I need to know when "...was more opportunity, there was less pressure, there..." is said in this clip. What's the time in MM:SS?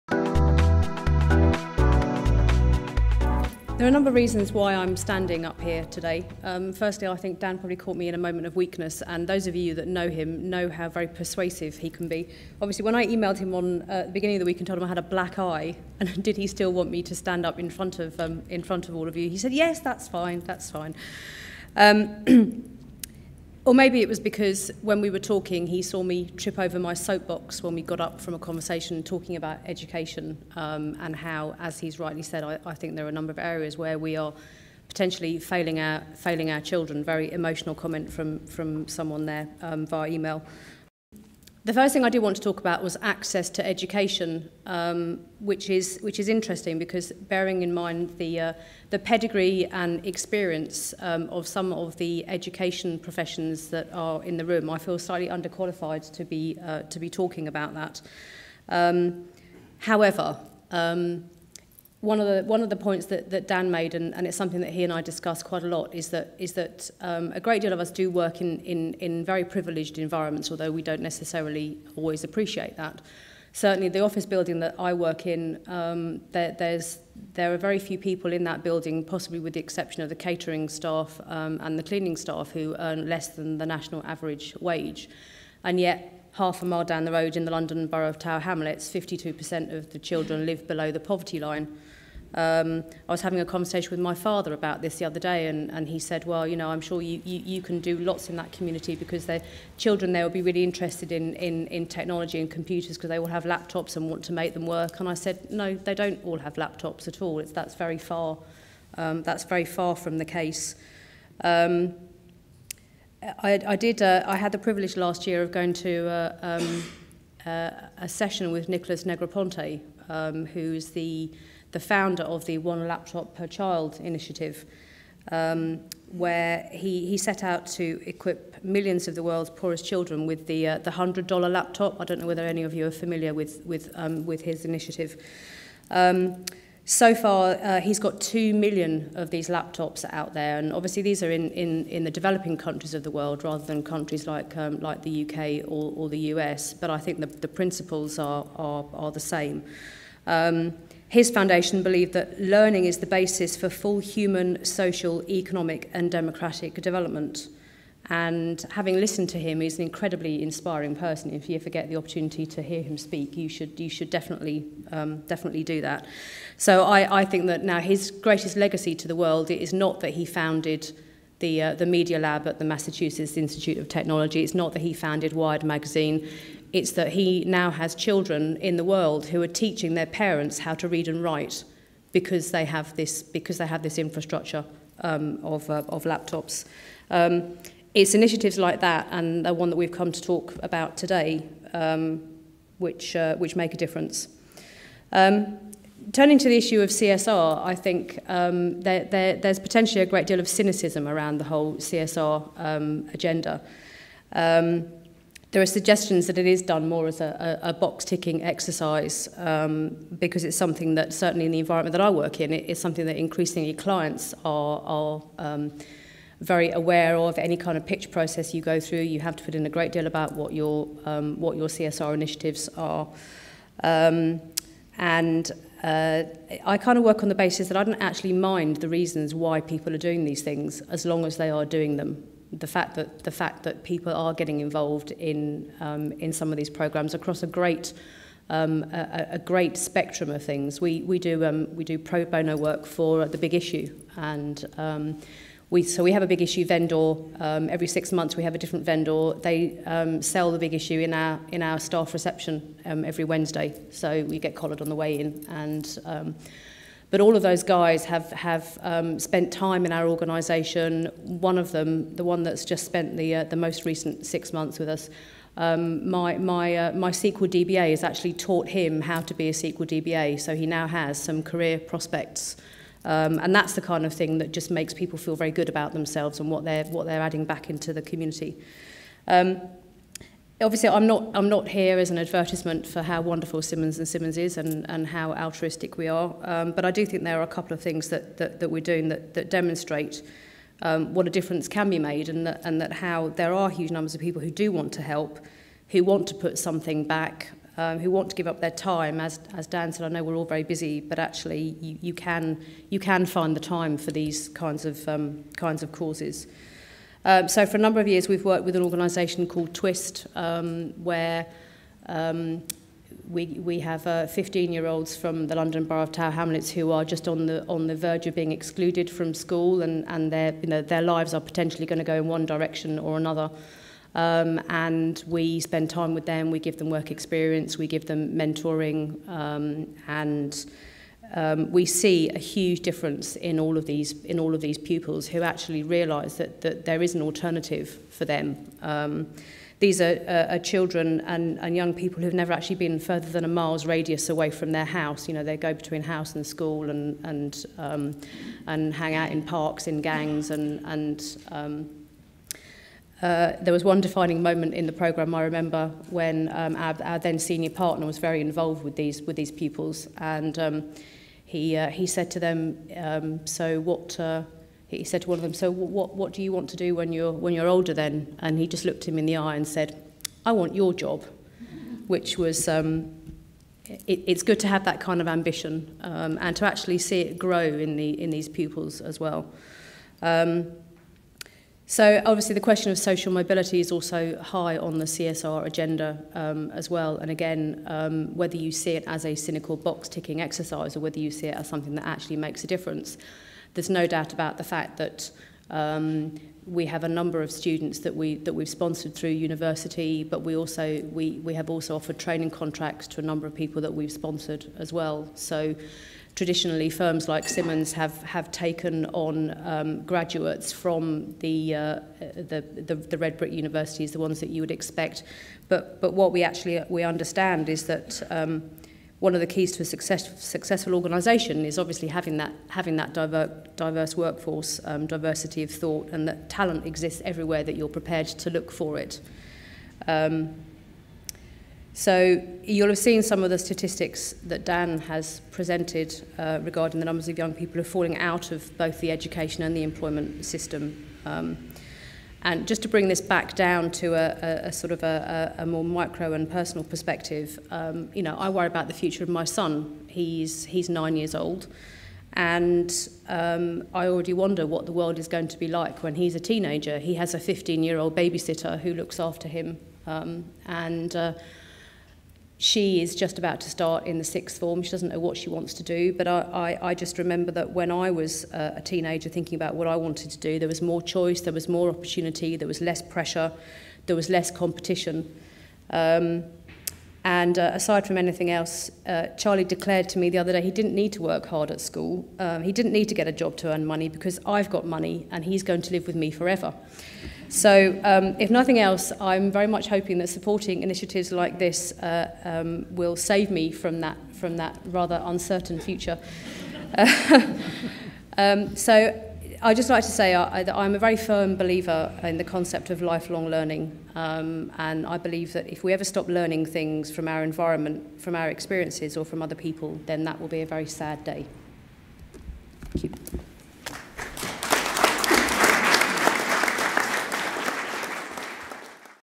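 07:51.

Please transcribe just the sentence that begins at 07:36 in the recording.
He has a 15-year-old babysitter who looks after him.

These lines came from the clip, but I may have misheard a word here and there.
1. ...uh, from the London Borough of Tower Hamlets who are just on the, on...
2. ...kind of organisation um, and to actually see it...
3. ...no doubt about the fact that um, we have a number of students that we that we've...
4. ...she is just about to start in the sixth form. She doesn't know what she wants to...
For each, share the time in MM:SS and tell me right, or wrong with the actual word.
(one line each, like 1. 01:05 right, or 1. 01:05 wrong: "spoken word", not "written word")
1. 05:15 right
2. 06:14 wrong: "ambition", not "organisation"
3. 06:33 right
4. 07:42 right.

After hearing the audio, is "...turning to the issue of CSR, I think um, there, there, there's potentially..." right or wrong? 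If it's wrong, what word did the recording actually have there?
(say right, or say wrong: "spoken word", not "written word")
right.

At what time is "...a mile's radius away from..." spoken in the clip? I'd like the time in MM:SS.
05:43.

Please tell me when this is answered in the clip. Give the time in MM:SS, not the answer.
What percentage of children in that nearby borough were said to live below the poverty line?
01:28.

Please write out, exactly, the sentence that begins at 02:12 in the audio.
I don't know whether any of you are familiar with with um, with his initiative.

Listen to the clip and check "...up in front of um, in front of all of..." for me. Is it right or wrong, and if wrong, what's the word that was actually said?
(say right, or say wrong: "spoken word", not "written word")
right.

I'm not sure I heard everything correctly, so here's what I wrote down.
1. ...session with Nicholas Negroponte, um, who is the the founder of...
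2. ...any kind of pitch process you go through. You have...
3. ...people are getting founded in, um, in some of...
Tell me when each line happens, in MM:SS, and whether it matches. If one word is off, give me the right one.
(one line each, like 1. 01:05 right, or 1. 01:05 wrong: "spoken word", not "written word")
1. 01:58 right
2. 03:37 right
3. 03:53 wrong: "involved", not "founded".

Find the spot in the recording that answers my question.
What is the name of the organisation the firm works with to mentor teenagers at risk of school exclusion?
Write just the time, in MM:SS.
05:09.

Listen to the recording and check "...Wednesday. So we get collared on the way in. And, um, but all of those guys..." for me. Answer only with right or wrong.
right.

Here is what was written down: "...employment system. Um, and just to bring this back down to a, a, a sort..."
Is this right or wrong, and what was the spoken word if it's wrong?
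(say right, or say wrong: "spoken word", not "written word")
right.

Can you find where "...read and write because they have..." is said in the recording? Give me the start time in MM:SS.
03:00.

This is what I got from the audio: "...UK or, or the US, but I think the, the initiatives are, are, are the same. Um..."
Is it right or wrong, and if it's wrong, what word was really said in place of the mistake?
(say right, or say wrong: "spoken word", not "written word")
wrong: "principles", not "initiatives".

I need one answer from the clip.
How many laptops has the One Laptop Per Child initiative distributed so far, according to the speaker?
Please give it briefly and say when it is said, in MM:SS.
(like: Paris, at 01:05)
2 million, at 02:18.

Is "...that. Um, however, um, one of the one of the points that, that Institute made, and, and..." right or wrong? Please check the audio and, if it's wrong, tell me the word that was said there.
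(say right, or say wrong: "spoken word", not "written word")
wrong: "Dan", not "Institute".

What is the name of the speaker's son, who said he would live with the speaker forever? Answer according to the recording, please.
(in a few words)
Charlie.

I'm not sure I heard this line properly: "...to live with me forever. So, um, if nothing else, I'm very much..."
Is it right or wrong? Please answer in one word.
right.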